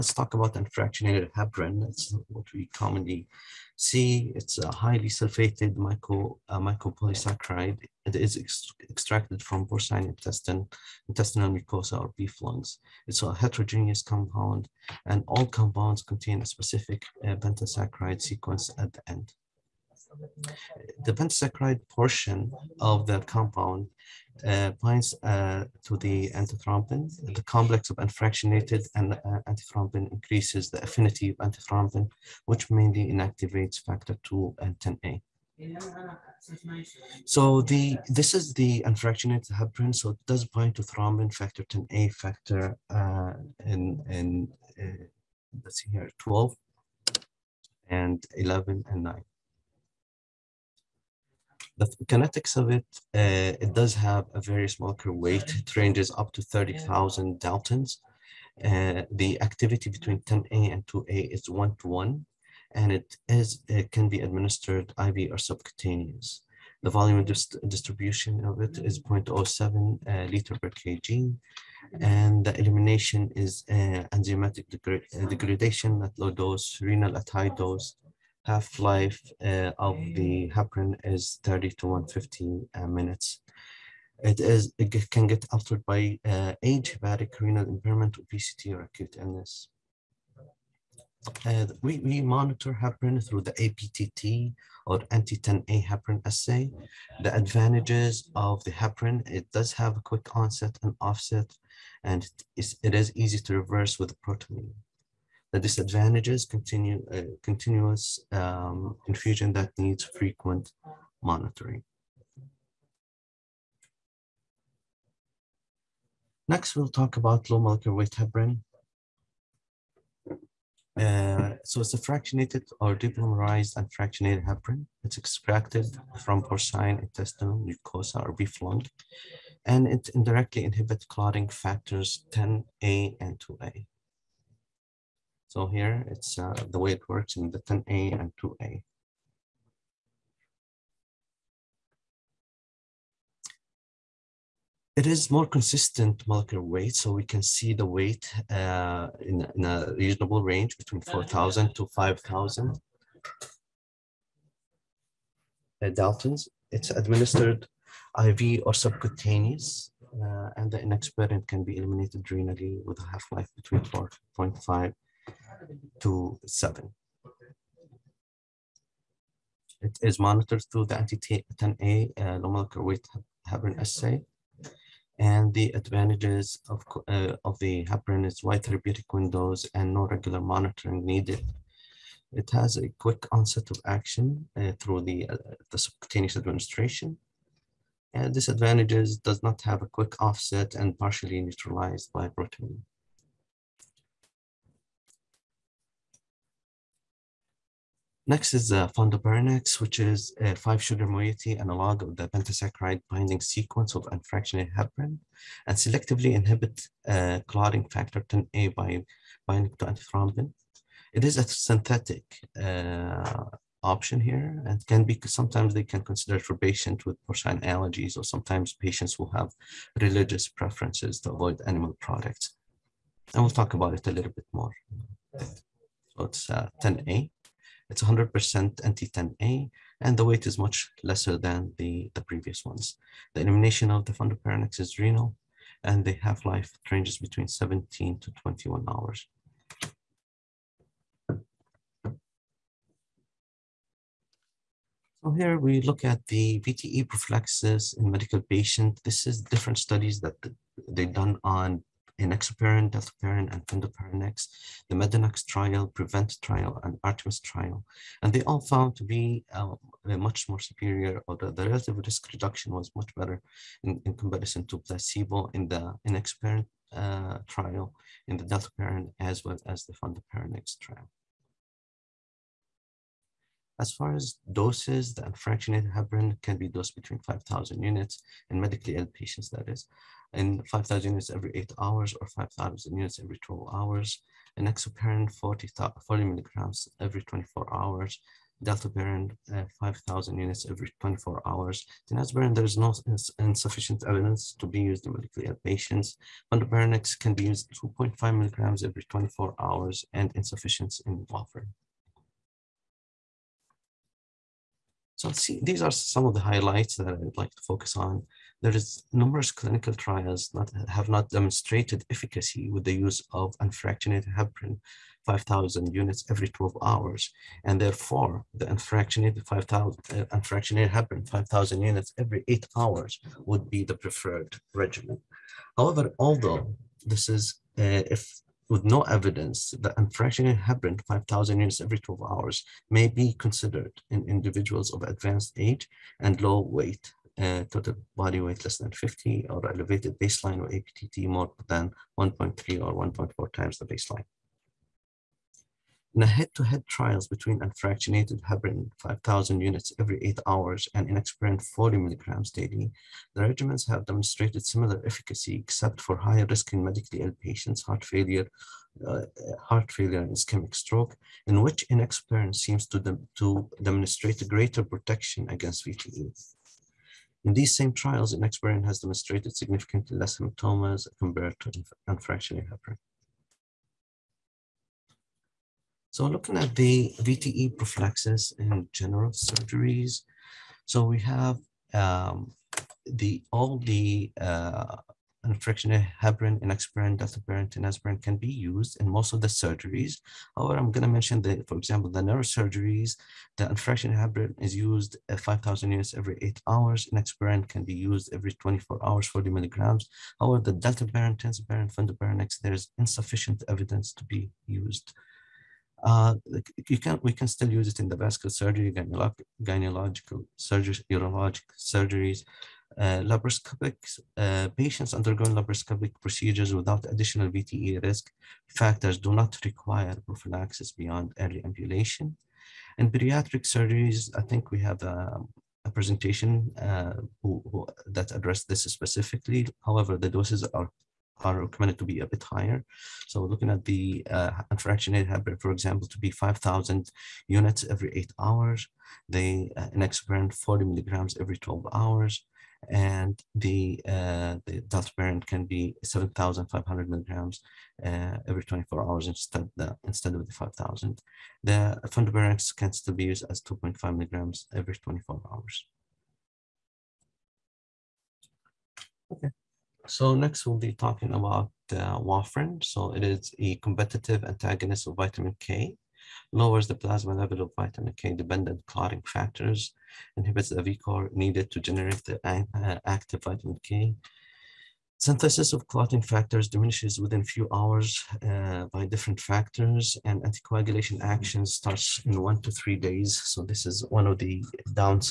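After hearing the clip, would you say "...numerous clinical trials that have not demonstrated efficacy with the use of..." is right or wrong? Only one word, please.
right.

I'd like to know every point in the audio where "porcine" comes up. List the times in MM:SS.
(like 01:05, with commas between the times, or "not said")
00:09, 02:06, 03:37.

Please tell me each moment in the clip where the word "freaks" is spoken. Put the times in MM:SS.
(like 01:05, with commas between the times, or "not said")
not said.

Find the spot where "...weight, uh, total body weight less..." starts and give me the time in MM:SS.
05:36.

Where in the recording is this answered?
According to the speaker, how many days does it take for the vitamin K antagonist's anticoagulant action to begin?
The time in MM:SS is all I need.
08:02.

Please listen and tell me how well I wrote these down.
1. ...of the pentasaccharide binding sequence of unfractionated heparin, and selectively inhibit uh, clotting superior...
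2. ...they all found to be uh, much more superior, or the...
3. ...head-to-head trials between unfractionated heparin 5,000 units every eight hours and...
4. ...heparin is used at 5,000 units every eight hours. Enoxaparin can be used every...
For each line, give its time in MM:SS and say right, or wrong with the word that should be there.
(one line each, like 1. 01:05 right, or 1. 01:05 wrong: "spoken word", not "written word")
1. 03:22 wrong: "factor", not "superior"
2. 04:18 right
3. 05:46 right
4. 06:34 right.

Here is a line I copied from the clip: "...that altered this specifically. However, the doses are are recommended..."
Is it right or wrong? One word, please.
wrong.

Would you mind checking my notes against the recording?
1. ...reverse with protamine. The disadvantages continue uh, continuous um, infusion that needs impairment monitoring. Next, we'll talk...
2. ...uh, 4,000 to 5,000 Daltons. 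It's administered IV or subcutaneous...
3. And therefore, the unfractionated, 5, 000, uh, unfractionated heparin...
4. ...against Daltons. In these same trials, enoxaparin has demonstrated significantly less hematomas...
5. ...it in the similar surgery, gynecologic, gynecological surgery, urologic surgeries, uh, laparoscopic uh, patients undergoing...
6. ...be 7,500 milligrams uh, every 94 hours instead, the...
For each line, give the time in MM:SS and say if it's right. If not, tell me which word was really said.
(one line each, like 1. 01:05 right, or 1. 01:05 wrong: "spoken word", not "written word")
1. 01:43 wrong: "frequent", not "impairment"
2. 02:31 right
3. 05:17 right
4. 06:05 wrong: "VTE", not "Daltons"
5. 06:47 wrong: "vascular", not "similar"
6. 07:25 wrong: "24", not "94".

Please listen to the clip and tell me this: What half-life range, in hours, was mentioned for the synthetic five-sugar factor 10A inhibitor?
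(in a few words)
17 to 21 hours.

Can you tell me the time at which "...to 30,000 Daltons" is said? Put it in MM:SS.
00:56.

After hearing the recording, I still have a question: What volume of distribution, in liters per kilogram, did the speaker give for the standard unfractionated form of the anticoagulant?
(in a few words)
0.07.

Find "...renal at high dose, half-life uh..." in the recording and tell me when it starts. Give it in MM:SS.
01:16.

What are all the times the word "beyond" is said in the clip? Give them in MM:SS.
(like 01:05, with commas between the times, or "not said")
07:00.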